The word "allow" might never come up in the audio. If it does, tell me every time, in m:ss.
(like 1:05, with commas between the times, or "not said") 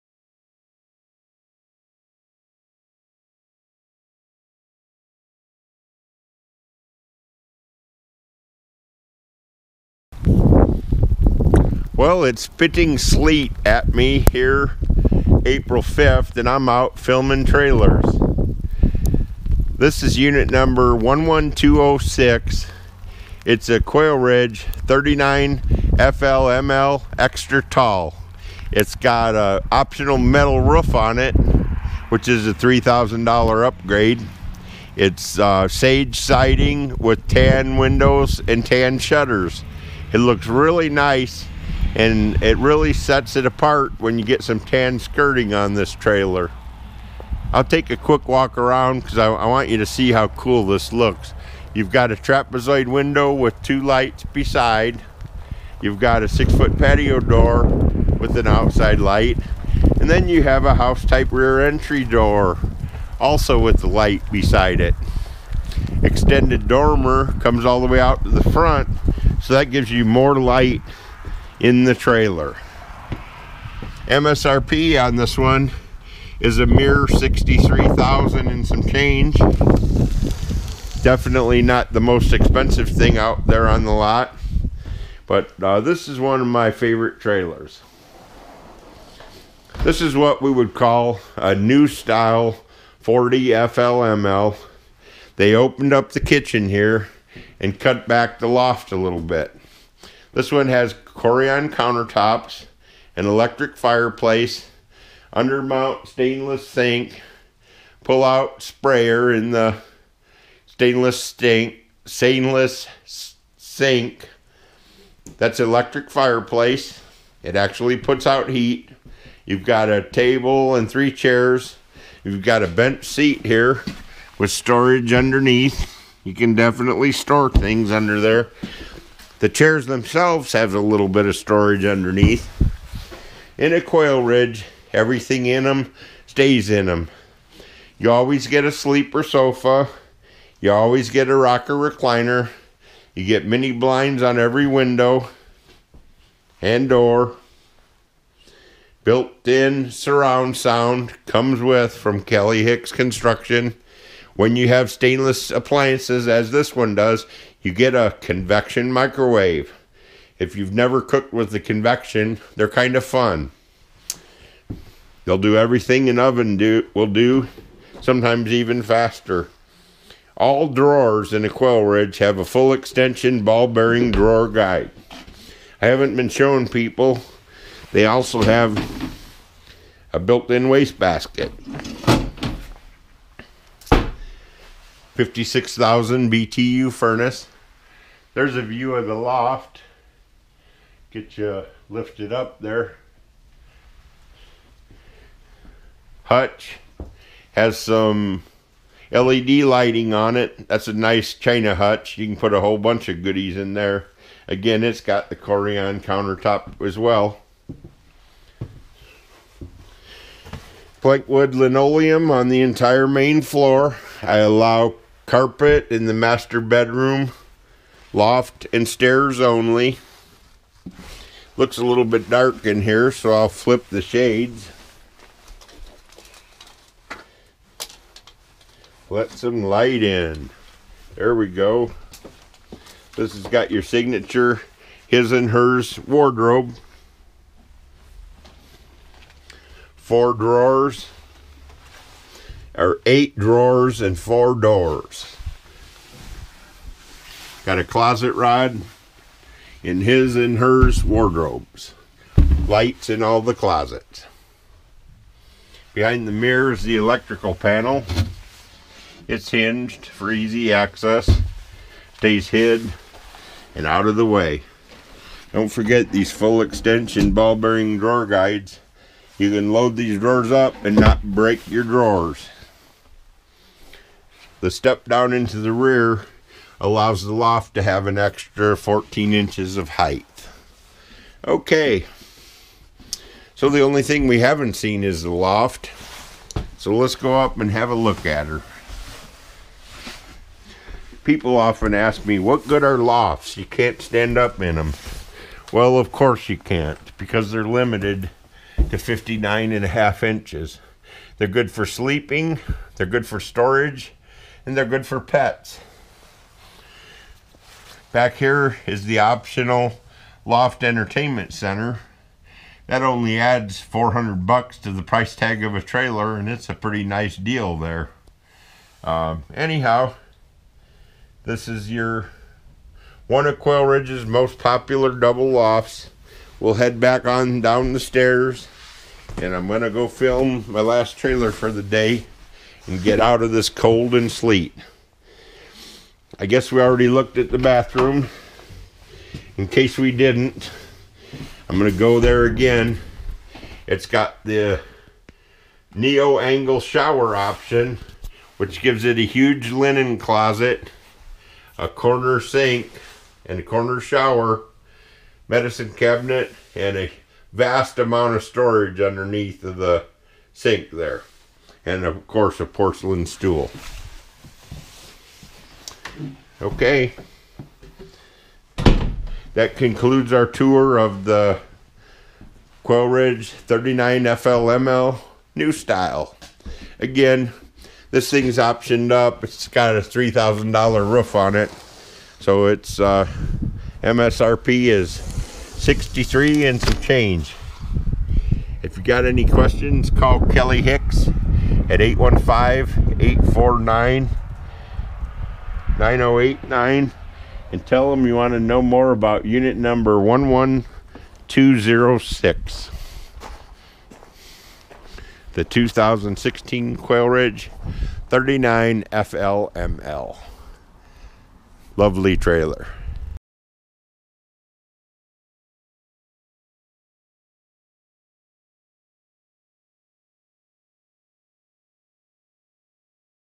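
3:34, 4:36.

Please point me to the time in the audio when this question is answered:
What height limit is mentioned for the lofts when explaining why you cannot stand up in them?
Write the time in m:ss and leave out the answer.
4:58.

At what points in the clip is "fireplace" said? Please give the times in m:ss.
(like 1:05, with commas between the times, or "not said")
1:43, 1:56.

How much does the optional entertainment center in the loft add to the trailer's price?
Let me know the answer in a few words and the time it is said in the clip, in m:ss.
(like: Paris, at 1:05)
$400, at 5:13.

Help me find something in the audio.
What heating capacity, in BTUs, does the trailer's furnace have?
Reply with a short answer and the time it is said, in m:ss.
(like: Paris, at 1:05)
56,000, at 3:05.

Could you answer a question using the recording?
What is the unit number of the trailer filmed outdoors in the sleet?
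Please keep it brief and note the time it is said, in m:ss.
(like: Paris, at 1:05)
11206, at 0:20.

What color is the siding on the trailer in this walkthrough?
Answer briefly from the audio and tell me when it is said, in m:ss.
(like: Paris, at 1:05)
Sage, at 0:35.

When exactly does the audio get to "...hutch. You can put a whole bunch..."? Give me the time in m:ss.
3:21.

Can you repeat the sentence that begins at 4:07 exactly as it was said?
Got a closet rod in his and hers wardrobes.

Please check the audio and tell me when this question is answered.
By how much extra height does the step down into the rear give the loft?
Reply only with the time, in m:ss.
4:38.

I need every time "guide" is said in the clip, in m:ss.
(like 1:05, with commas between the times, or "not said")
2:54, 4:28.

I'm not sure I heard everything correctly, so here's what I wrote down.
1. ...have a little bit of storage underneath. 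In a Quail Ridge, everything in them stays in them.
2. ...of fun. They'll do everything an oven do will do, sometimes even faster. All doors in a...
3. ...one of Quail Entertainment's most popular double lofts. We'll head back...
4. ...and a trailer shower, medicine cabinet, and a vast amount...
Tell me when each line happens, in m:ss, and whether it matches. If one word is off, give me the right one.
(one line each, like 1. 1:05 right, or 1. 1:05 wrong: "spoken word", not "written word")
1. 2:10 right
2. 2:42 wrong: "drawers", not "doors"
3. 5:23 wrong: "Ridge", not "Entertainment"
4. 5:53 wrong: "corner", not "trailer".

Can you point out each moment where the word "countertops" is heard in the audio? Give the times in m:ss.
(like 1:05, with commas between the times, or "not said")
1:41, 3:26.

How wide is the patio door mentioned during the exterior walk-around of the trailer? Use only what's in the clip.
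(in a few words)
6 foot.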